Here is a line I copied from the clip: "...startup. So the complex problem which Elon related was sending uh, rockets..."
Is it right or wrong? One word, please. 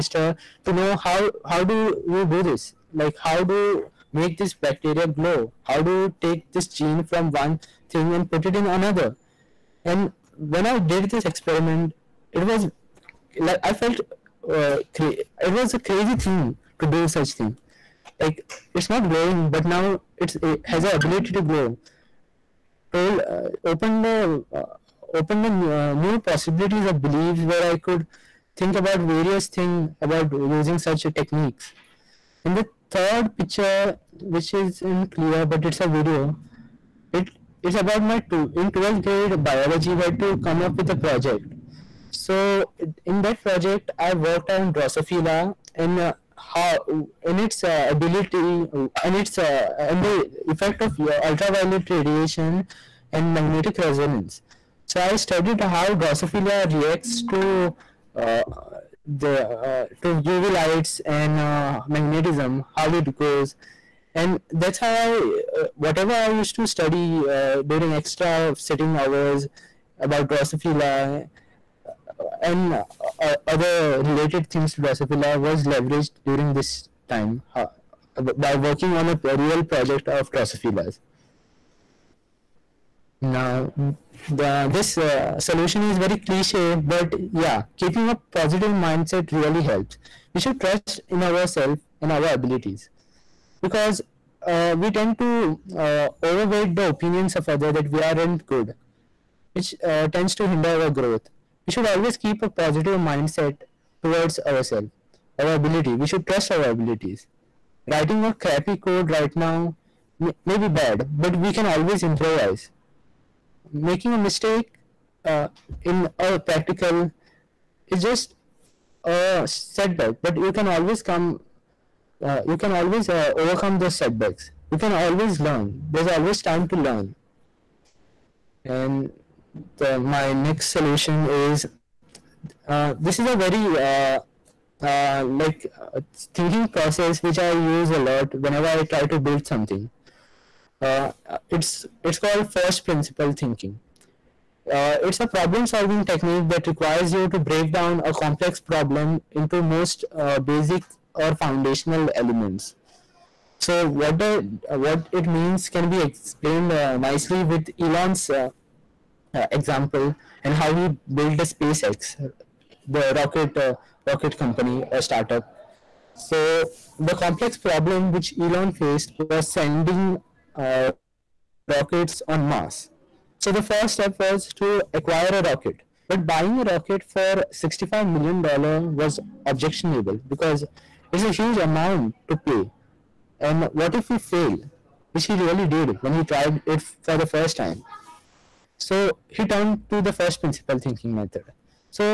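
wrong.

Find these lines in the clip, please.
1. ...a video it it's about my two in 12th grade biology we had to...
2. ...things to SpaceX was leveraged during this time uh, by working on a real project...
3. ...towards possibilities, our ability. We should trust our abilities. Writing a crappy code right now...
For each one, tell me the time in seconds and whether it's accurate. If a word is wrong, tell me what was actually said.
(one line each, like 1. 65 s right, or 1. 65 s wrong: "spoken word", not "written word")
1. 35 s right
2. 74 s wrong: "Drosophila", not "SpaceX"
3. 104 s wrong: "ourselves", not "possibilities".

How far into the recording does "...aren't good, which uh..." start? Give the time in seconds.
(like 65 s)
97 s.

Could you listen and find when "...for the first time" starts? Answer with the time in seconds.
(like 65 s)
186 s.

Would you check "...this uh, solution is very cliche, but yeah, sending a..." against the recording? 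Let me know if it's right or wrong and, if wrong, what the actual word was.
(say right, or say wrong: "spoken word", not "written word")
wrong: "keeping", not "sending".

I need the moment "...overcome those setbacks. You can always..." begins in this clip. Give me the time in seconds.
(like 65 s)
123 s.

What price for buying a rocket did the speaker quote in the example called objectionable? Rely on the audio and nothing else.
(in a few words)
$65 million.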